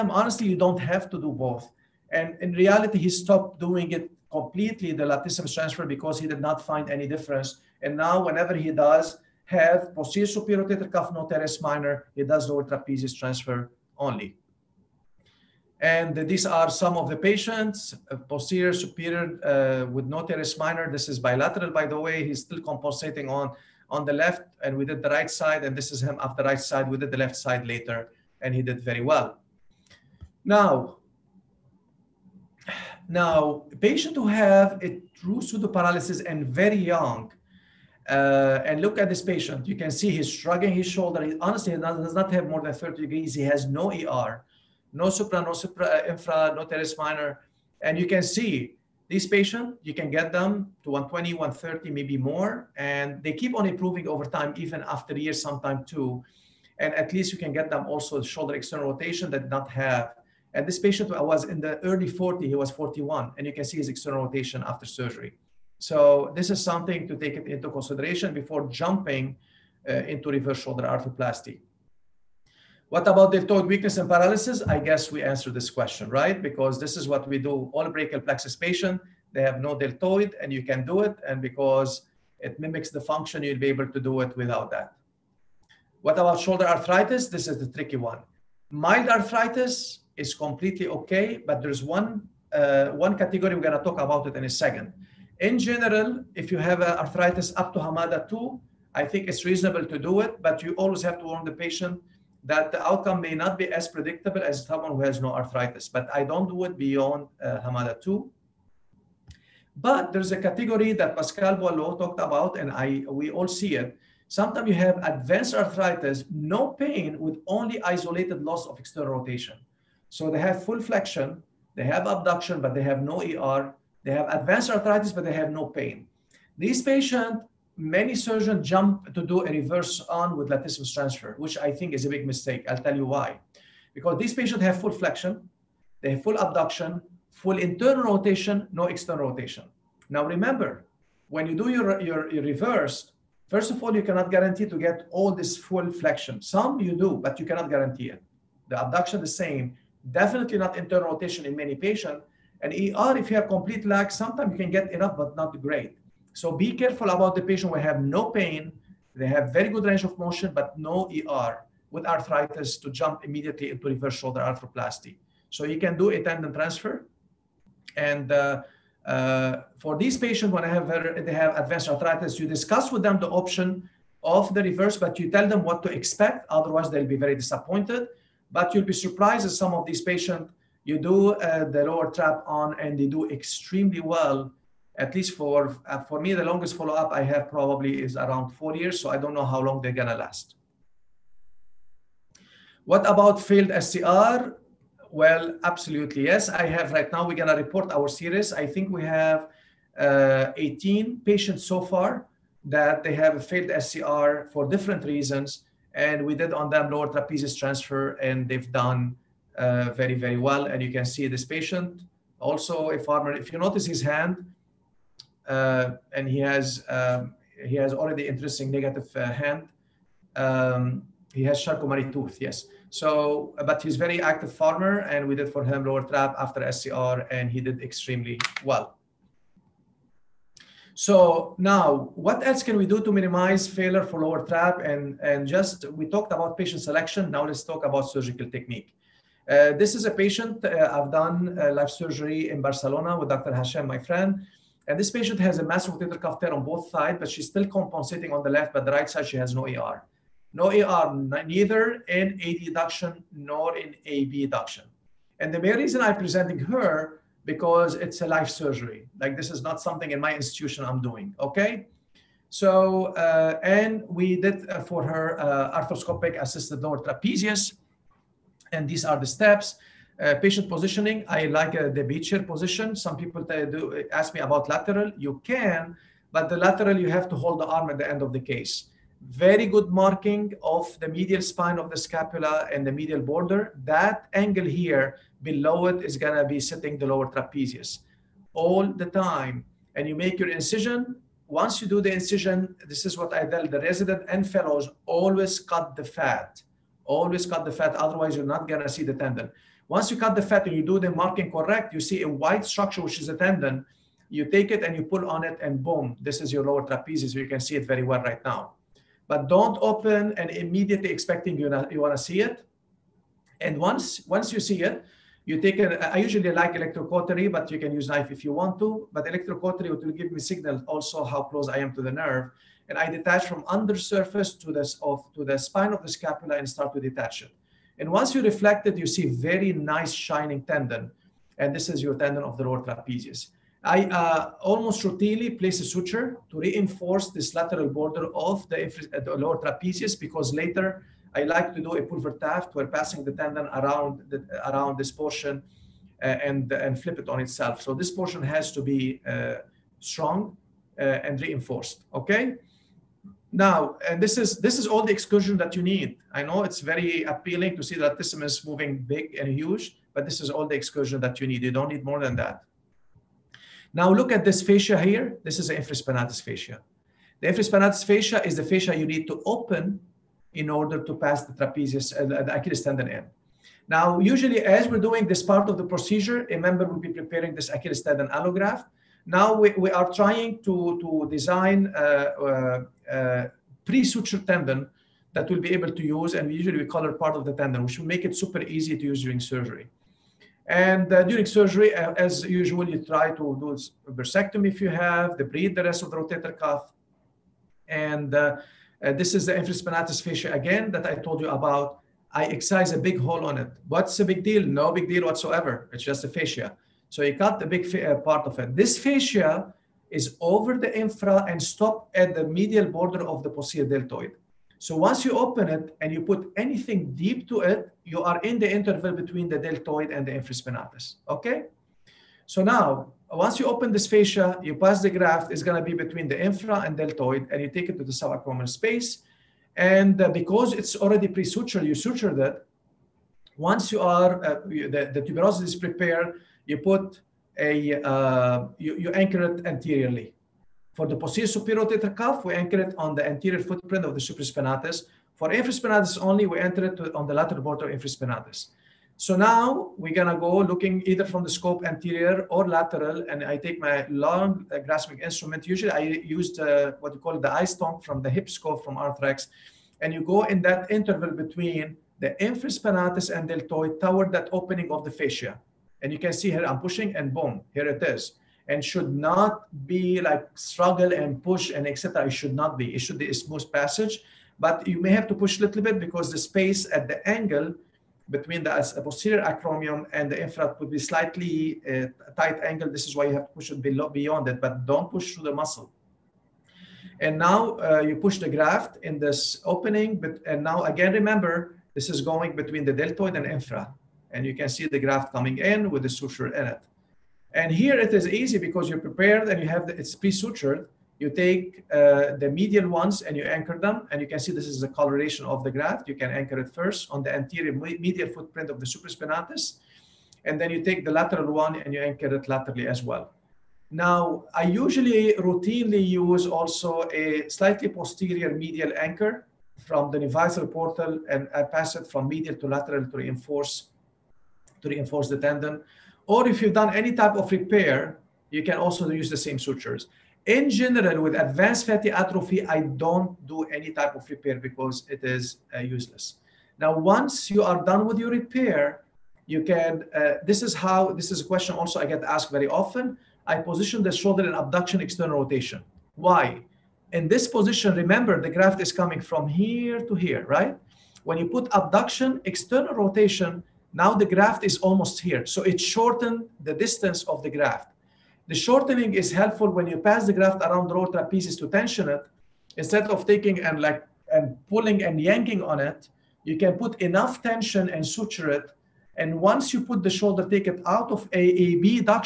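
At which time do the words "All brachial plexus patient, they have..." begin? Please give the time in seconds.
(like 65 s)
77 s.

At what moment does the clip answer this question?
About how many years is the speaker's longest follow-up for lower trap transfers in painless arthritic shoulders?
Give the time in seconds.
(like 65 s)
188 s.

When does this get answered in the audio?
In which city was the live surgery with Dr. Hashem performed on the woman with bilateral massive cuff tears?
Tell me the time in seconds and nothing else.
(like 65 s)
242 s.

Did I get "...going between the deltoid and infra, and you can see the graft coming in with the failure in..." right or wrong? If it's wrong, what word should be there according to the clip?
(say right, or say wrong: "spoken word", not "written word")
wrong: "suture", not "failure".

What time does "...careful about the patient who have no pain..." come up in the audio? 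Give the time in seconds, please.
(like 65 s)
156 s.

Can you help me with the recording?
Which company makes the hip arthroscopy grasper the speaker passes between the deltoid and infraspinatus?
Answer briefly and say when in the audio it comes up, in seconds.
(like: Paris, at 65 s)
Arthrex, at 458 s.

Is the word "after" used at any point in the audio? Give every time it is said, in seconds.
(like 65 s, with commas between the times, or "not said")
26 s, 54 s, 64 s, 226 s.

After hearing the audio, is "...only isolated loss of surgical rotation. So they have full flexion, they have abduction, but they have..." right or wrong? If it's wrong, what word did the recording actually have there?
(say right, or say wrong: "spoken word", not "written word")
wrong: "external", not "surgical".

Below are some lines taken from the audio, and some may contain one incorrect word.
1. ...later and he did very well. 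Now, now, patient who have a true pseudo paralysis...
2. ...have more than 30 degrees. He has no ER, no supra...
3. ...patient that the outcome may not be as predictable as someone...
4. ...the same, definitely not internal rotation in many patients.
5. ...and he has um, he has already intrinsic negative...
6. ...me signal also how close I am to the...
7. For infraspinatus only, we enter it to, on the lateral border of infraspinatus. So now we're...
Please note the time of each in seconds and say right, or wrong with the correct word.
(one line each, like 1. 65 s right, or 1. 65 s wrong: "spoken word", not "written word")
1. 27 s right
2. 42 s right
3. 101 s right
4. 149 s right
5. 216 s right
6. 320 s right
7. 445 s right.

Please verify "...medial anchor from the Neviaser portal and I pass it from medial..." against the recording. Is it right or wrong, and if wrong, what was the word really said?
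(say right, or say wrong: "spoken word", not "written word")
right.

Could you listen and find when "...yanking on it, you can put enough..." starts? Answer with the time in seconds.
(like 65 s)
565 s.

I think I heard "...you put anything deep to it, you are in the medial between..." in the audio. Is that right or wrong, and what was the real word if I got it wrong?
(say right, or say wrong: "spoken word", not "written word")
wrong: "interval", not "medial".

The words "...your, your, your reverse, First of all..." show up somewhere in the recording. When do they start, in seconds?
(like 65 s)
141 s.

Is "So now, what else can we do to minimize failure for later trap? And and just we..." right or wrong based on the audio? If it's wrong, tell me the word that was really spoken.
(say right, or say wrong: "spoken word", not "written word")
wrong: "lower", not "later".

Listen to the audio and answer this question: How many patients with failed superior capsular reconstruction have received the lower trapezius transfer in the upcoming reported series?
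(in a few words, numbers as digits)
18.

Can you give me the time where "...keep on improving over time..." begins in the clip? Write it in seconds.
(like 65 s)
53 s.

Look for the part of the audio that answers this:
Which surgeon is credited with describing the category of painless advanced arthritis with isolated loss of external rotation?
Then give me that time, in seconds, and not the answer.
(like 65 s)
111 s.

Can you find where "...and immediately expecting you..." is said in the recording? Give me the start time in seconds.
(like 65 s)
310 s.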